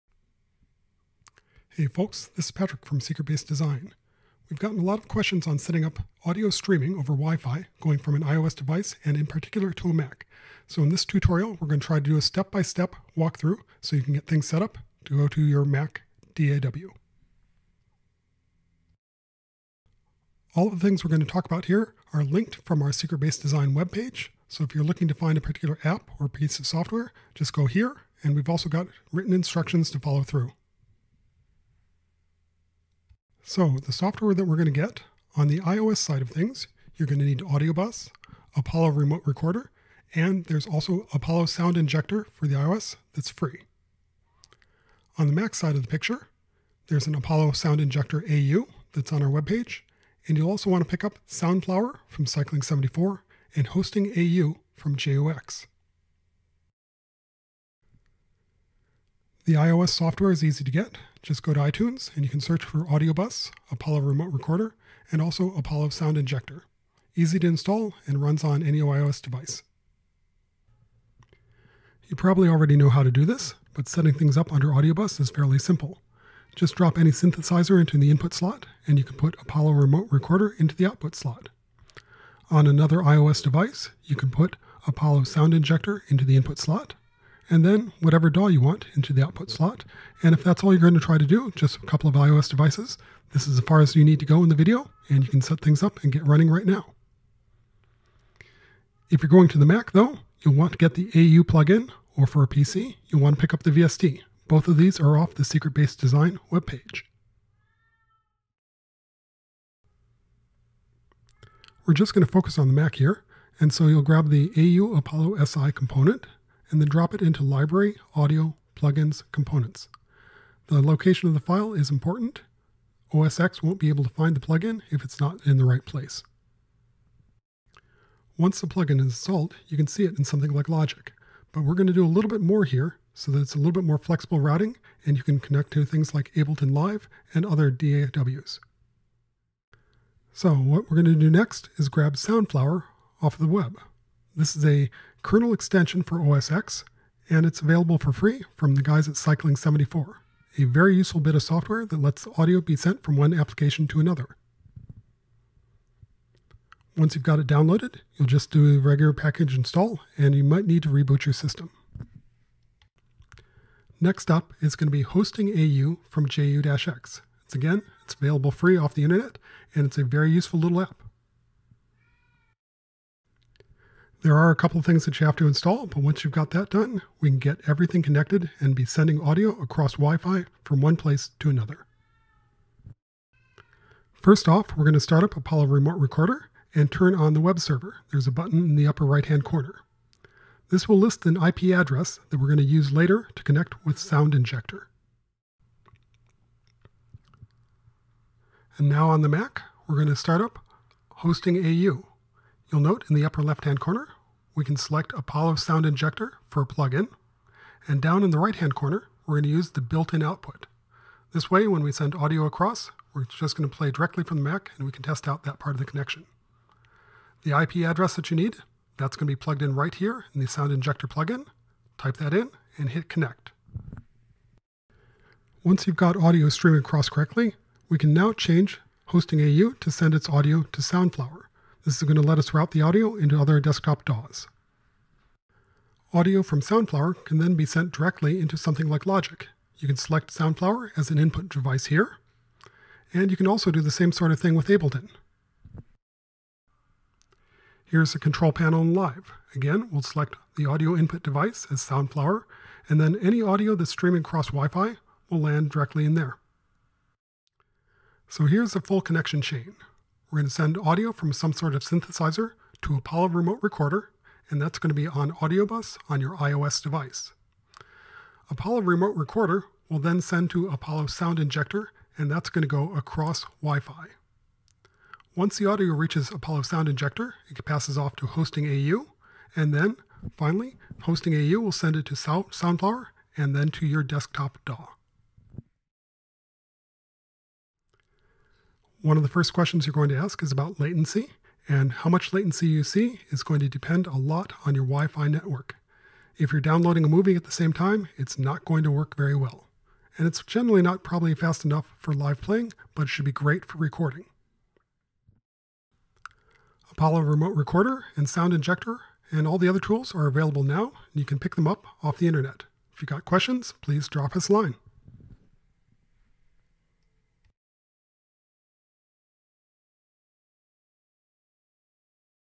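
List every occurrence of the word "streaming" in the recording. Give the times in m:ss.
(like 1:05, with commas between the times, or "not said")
0:06, 3:46, 4:13.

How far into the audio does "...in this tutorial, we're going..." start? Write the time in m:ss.
0:10.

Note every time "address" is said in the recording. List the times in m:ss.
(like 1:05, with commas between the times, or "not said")
3:11, 3:37.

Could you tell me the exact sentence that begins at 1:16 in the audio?
Just drop any synthesizer into the input slot, and you can put Apollo Remote Recorder into the output slot.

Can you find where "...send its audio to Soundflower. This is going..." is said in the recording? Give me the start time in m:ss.
3:49.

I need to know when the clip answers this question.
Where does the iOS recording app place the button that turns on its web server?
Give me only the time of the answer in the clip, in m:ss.
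3:08.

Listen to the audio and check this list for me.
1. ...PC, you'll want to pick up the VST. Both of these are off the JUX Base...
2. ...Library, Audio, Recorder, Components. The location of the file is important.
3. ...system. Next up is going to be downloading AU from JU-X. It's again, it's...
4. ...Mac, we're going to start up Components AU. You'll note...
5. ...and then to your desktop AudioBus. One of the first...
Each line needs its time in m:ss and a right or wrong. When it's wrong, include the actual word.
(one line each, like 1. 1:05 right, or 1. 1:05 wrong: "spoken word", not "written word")
1. 1:42 wrong: "Secret", not "JUX"
2. 1:57 wrong: "Plugins", not "Recorder"
3. 2:41 wrong: "hosting", not "downloading"
4. 3:19 wrong: "Hosting", not "Components"
5. 4:43 wrong: "DAW", not "AudioBus".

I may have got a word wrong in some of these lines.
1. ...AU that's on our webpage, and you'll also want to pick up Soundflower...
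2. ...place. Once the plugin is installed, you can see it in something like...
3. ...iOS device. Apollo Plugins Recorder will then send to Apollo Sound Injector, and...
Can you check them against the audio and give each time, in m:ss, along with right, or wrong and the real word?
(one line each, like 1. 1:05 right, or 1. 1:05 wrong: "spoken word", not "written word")
1. 0:48 right
2. 2:05 right
3. 4:26 wrong: "Remote", not "Plugins".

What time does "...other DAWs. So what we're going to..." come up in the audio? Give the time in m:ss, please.
2:17.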